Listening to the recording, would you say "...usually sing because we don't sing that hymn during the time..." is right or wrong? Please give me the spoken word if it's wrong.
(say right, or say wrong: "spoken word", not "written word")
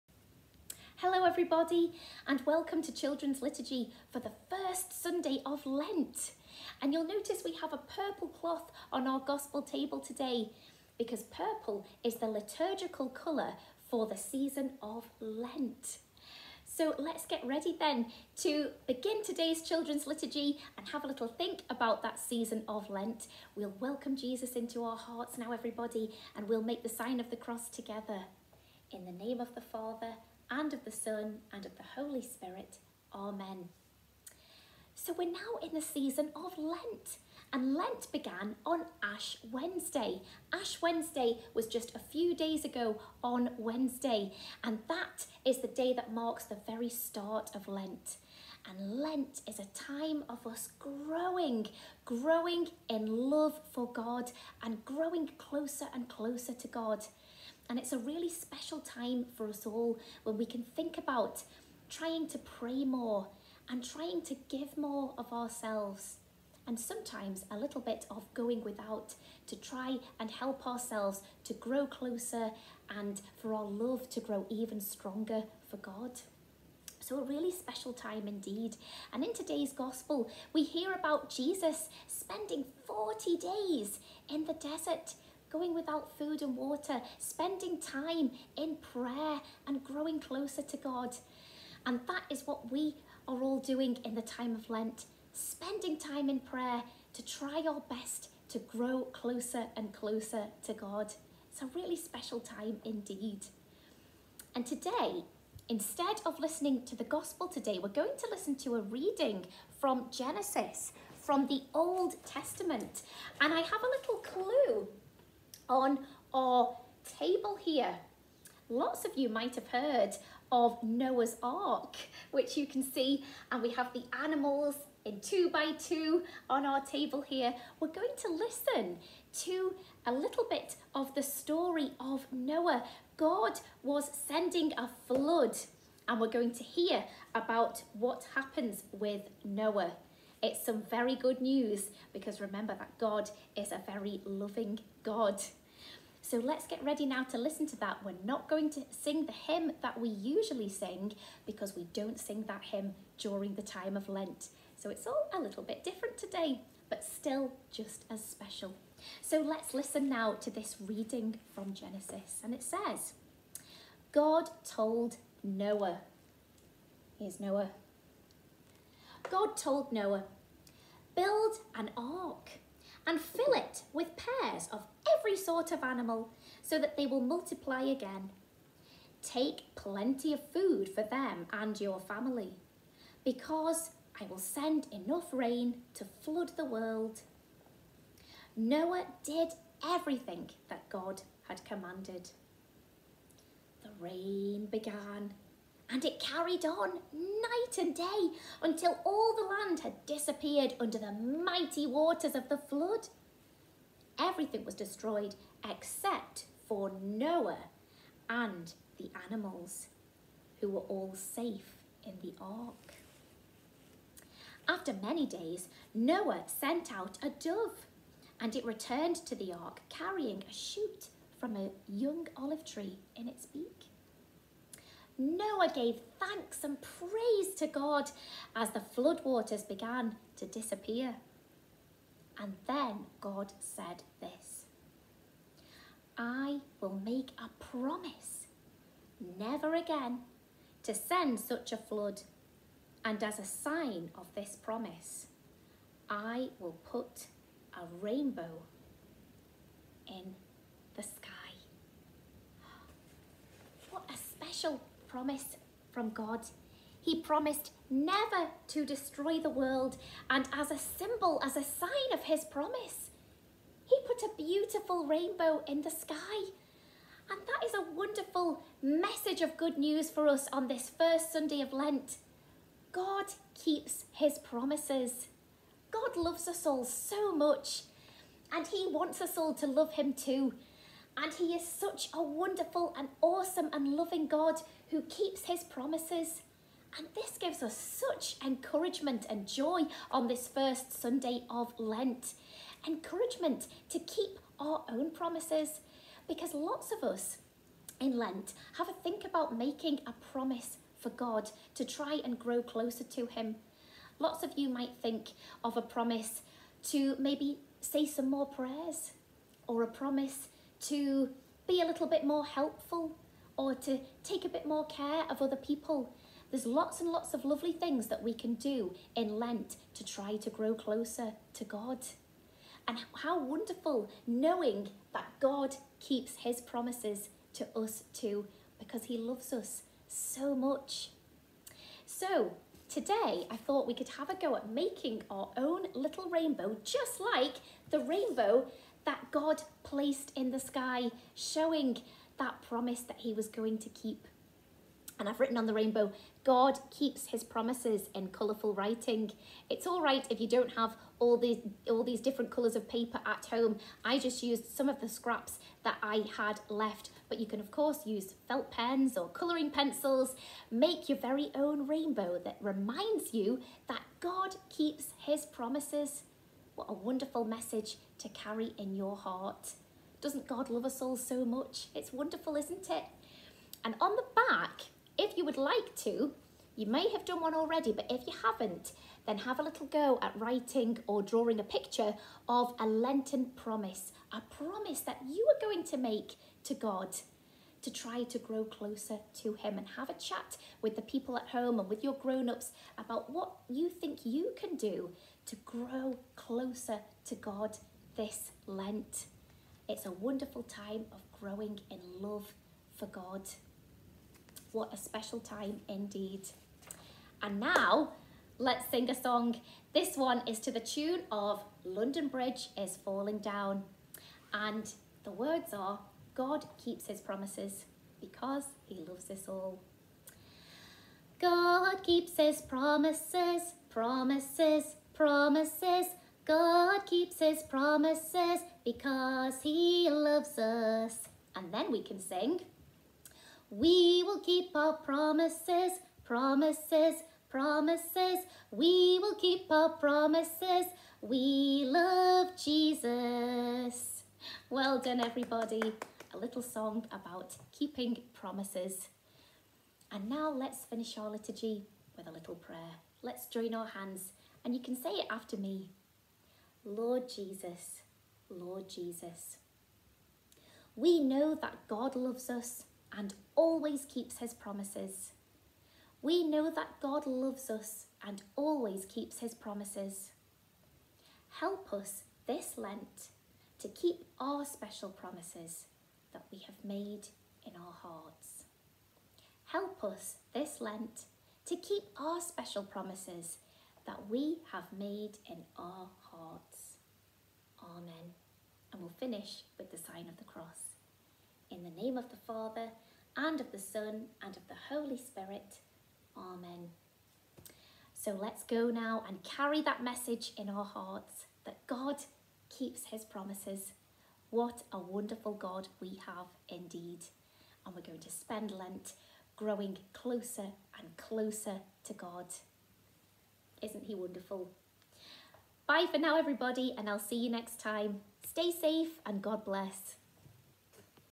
right.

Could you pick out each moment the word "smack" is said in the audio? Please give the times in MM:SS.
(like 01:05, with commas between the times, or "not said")
not said.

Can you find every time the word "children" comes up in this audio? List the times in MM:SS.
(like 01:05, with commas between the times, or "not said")
00:02, 00:19.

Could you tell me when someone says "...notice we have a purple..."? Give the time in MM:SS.
00:07.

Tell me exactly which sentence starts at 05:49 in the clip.
It's all right if you don't have all these all these different colours of paper at home.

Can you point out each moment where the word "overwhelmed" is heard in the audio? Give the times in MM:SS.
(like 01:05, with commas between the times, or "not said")
not said.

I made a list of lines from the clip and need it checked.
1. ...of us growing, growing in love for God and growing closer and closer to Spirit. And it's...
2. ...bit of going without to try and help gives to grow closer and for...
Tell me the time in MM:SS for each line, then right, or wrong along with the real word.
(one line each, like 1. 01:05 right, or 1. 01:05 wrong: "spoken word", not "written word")
1. 00:50 wrong: "God", not "Spirit"
2. 01:07 wrong: "ourselves", not "gives".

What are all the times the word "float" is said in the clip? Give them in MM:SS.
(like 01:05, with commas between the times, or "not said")
not said.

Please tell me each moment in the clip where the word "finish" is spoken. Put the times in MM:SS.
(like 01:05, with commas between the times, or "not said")
07:30, 08:09.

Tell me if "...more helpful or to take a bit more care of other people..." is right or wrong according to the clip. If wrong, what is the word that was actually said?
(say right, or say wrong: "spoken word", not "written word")
right.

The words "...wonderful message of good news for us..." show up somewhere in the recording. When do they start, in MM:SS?
04:27.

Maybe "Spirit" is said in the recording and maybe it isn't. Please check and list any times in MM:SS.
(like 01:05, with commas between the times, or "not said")
00:32, 08:15.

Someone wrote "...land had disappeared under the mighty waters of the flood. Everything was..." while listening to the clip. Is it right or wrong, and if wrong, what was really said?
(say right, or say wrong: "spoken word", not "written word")
right.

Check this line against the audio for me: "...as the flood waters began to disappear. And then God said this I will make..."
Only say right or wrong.
right.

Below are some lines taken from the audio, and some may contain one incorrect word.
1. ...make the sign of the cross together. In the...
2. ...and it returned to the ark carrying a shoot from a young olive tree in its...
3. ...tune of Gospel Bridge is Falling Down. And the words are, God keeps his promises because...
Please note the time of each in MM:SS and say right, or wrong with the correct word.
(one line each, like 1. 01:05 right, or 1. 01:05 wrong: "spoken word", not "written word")
1. 00:26 right
2. 03:38 right
3. 06:50 wrong: "London", not "Gospel".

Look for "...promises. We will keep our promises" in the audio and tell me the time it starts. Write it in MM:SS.
07:17.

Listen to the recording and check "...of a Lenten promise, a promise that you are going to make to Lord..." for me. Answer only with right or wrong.
wrong.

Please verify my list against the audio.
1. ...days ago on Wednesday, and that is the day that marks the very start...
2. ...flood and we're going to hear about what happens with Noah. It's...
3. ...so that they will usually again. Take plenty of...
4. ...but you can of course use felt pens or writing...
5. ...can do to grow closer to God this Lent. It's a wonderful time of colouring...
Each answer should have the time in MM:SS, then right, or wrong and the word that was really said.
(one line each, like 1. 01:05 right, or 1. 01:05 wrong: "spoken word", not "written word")
1. 00:42 right
2. 02:15 right
3. 02:56 wrong: "multiply", not "usually"
4. 05:57 wrong: "colouring", not "writing"
5. 06:34 wrong: "growing", not "colouring".